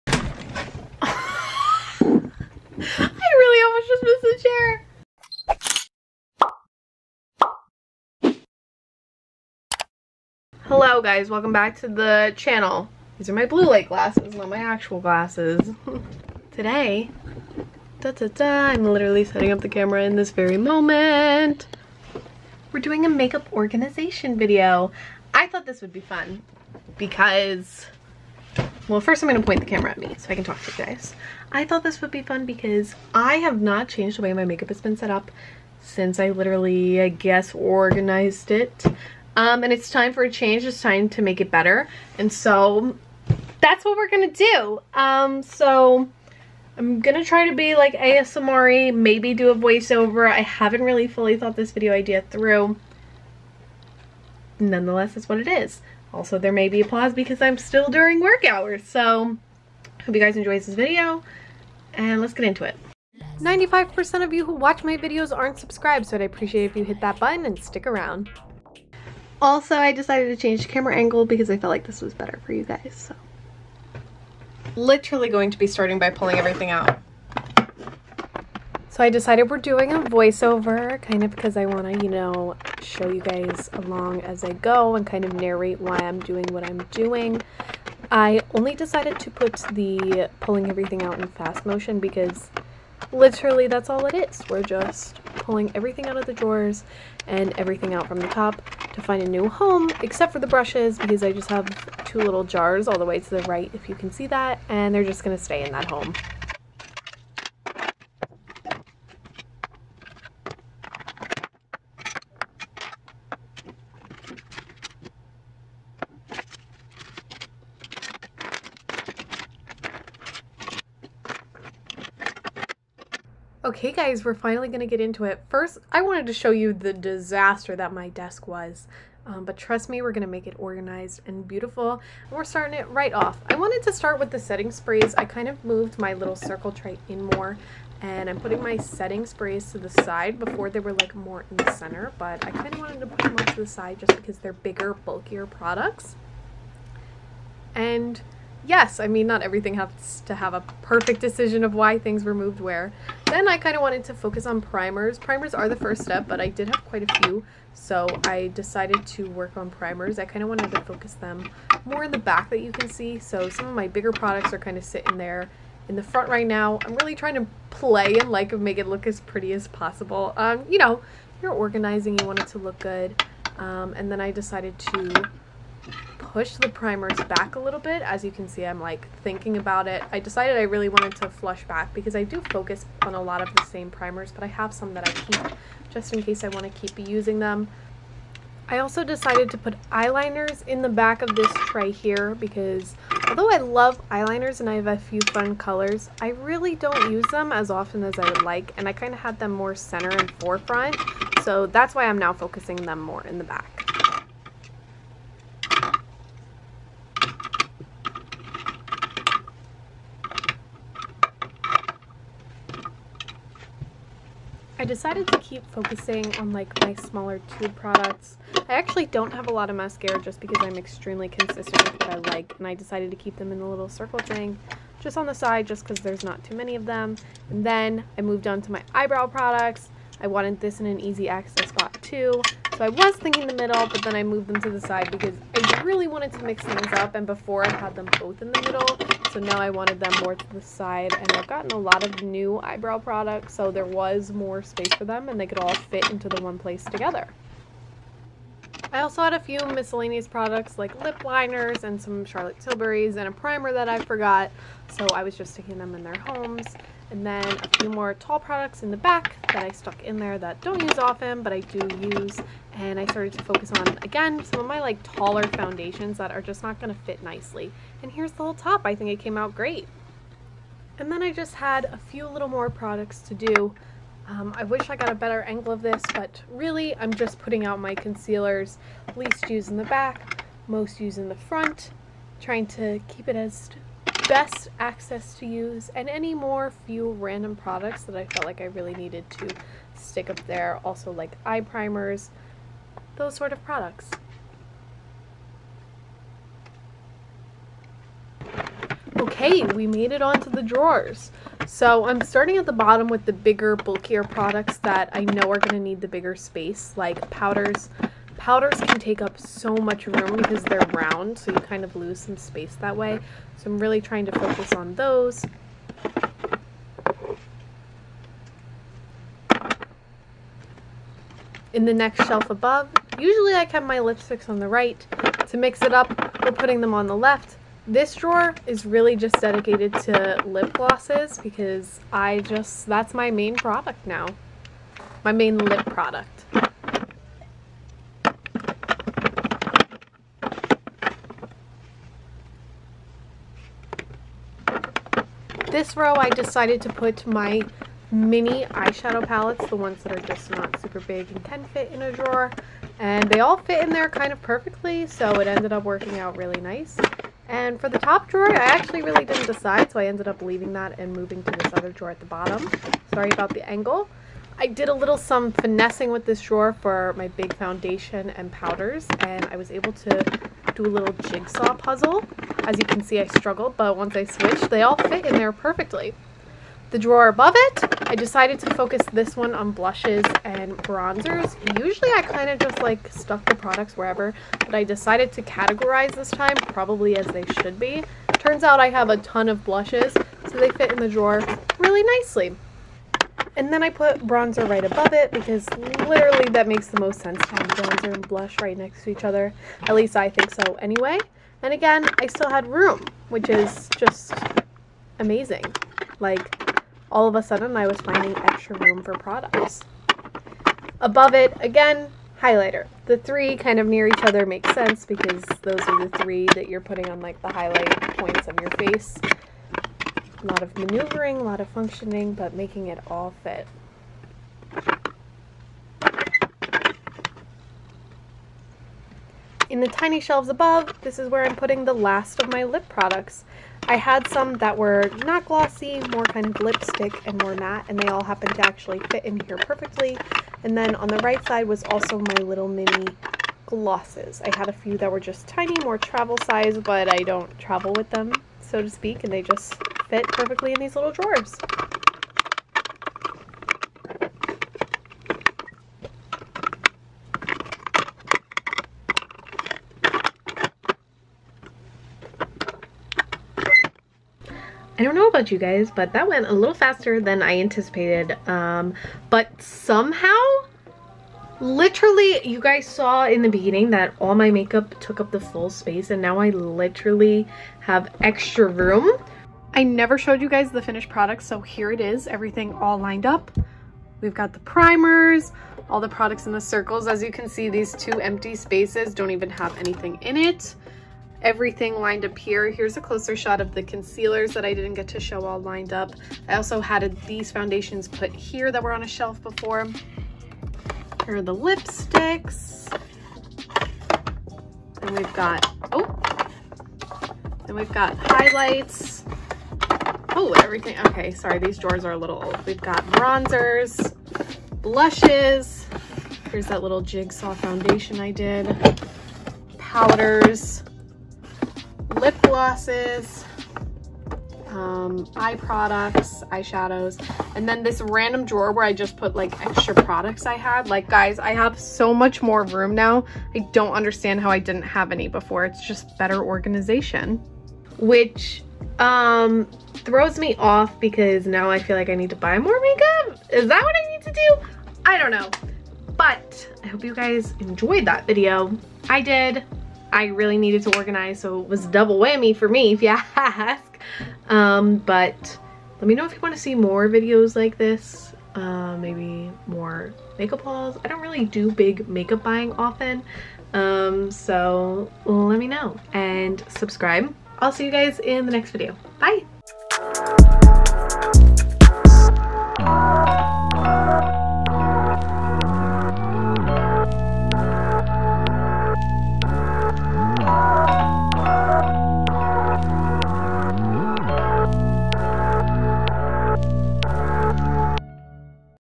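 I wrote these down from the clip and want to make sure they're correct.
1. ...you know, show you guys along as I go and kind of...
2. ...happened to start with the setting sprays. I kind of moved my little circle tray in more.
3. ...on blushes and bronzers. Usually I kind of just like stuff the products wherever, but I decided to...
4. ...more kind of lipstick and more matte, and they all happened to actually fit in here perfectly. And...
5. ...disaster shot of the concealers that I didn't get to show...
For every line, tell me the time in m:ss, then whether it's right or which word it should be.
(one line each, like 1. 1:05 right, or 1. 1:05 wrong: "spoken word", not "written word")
1. 1:22 right
2. 2:13 wrong: "wanted", not "happened"
3. 6:19 right
4. 7:16 right
5. 8:13 wrong: "closer", not "disaster".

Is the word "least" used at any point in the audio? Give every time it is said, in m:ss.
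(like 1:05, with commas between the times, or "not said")
4:39, 6:39.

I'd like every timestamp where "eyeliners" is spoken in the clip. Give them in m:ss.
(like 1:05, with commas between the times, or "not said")
3:09, 3:14.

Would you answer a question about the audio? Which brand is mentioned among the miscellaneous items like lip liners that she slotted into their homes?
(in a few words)
Charlotte Tilbury.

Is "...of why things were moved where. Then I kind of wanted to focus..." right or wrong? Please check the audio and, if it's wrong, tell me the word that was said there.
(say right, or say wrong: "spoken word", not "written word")
right.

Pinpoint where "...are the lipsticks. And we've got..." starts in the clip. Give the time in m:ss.
8:21.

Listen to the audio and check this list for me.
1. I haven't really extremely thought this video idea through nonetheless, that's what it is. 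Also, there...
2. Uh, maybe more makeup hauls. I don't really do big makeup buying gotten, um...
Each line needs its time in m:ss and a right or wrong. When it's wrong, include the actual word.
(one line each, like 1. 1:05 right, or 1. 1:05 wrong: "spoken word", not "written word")
1. 0:50 wrong: "fully", not "extremely"
2. 9:18 wrong: "often", not "gotten".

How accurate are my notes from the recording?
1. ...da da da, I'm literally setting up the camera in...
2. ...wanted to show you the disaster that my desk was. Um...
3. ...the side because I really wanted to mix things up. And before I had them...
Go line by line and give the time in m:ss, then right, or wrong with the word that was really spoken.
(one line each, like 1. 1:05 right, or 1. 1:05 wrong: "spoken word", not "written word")
1. 0:17 right
2. 2:06 right
3. 3:54 right.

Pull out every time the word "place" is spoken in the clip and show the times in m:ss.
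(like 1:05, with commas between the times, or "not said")
4:06.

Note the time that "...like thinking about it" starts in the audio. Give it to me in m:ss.
2:58.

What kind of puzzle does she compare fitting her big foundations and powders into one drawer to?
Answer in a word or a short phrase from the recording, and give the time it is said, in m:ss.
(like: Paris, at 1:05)
jigsaw puzzle, at 6:11.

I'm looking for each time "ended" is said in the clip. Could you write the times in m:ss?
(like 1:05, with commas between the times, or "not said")
5:55, 6:00.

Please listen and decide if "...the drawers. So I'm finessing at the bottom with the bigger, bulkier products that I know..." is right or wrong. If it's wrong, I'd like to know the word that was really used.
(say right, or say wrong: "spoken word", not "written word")
wrong: "starting", not "finessing".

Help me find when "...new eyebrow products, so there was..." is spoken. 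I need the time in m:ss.
4:02.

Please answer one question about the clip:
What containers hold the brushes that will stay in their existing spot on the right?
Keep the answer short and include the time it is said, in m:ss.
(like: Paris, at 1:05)
two little jars, at 1:42.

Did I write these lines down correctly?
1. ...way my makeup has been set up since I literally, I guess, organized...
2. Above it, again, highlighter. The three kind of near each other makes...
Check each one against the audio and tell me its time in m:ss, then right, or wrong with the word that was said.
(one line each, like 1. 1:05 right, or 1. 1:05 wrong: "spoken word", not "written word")
1. 0:34 right
2. 6:51 right.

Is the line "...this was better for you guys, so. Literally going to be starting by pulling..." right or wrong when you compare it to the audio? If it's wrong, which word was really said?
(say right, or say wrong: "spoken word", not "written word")
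right.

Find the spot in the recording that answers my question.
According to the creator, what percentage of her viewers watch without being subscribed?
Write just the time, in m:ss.
1:03.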